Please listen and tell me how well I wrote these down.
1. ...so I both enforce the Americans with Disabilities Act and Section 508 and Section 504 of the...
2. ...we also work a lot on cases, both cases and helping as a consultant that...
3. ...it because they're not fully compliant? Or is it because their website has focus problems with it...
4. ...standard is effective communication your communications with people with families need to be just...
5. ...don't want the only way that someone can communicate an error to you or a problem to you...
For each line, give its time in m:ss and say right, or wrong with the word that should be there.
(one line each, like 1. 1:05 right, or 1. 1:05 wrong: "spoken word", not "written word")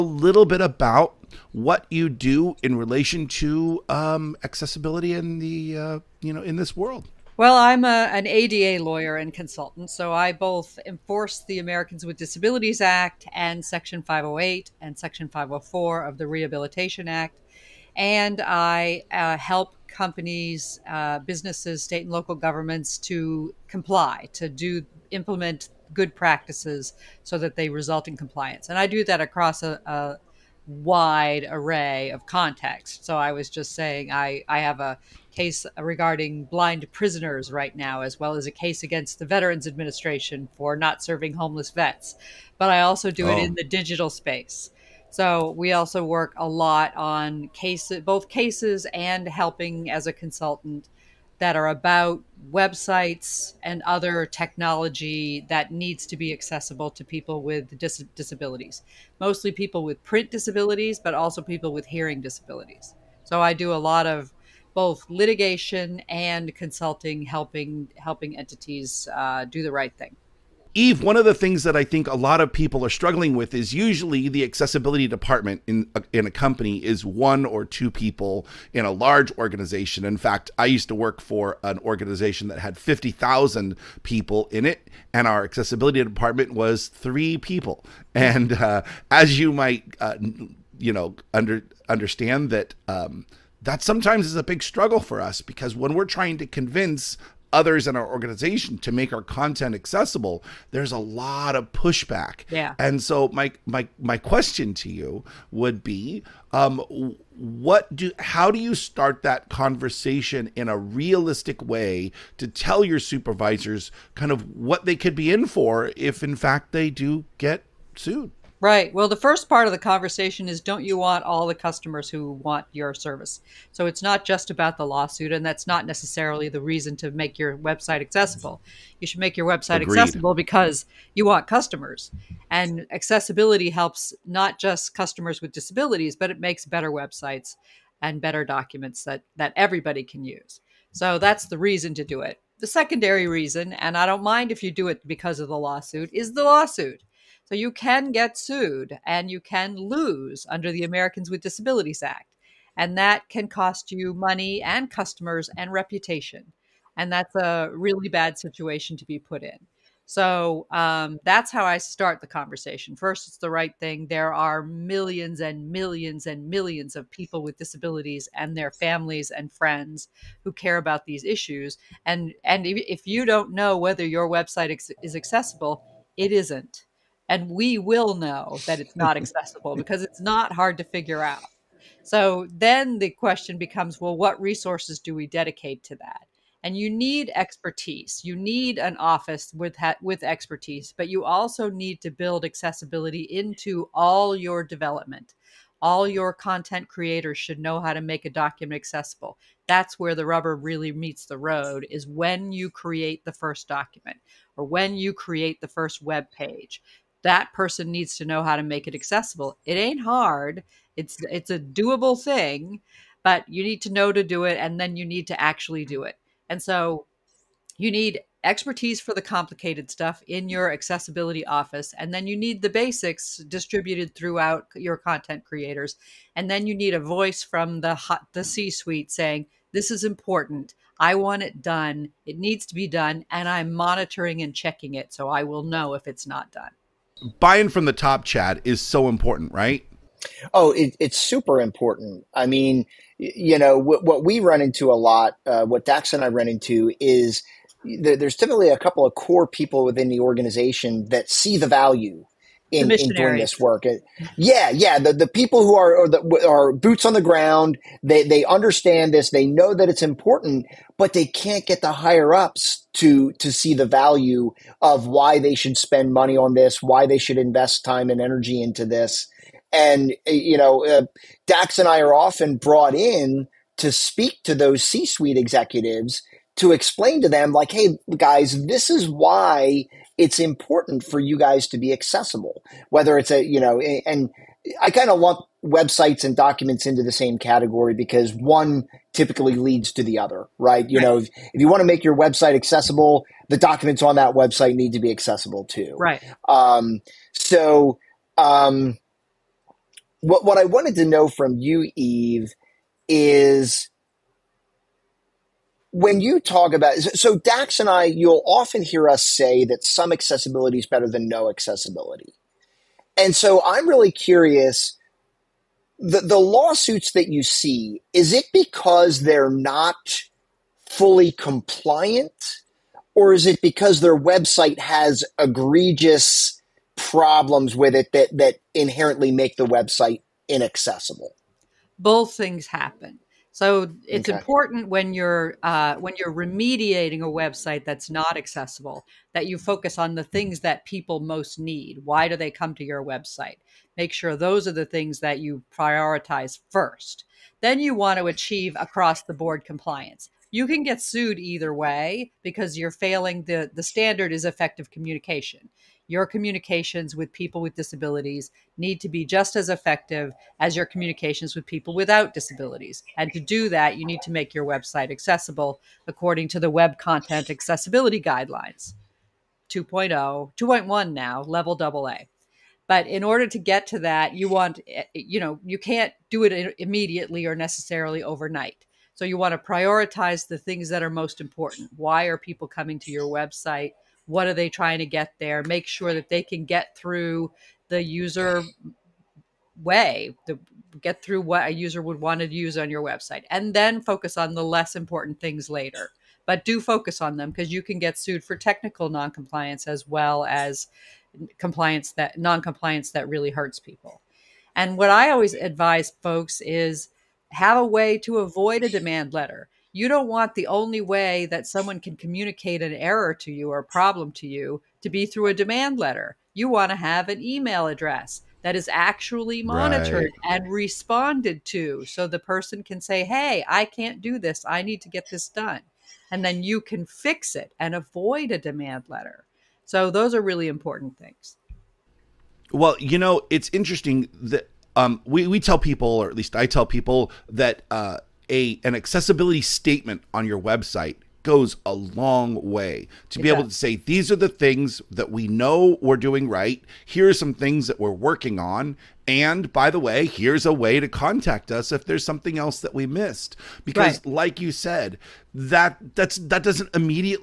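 1. 0:09 right
2. 0:45 right
3. 5:18 wrong: "egregious", not "focus"
4. 5:53 wrong: "disabilities", not "families"
5. 6:50 right.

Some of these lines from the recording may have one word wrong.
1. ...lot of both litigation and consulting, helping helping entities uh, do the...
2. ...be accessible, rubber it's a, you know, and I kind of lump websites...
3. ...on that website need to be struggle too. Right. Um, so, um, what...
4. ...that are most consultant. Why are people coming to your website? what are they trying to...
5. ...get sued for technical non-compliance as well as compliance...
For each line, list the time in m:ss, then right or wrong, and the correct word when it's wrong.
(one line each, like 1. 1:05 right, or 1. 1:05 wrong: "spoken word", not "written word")
1. 1:03 right
2. 4:41 wrong: "whether", not "rubber"
3. 4:54 wrong: "accessible", not "struggle"
4. 6:20 wrong: "important", not "consultant"
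5. 6:37 right.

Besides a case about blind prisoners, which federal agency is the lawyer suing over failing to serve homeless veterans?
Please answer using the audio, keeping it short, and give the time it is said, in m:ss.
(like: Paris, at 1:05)
Veterans Administration, at 0:39.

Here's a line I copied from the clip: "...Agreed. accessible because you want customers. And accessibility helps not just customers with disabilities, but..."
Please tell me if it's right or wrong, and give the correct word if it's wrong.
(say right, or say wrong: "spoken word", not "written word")
right.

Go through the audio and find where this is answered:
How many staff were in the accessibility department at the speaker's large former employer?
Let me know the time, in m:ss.
1:26.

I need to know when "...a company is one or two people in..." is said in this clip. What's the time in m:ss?
1:16.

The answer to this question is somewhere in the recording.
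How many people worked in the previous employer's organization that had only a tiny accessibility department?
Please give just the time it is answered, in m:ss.
1:22.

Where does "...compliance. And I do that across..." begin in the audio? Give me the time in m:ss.
0:28.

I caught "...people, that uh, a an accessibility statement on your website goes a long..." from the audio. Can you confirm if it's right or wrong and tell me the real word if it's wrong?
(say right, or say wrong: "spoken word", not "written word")
right.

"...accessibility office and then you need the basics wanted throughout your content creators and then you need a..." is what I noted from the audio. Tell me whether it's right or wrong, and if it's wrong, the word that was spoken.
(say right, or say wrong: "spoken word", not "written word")
wrong: "distributed", not "wanted".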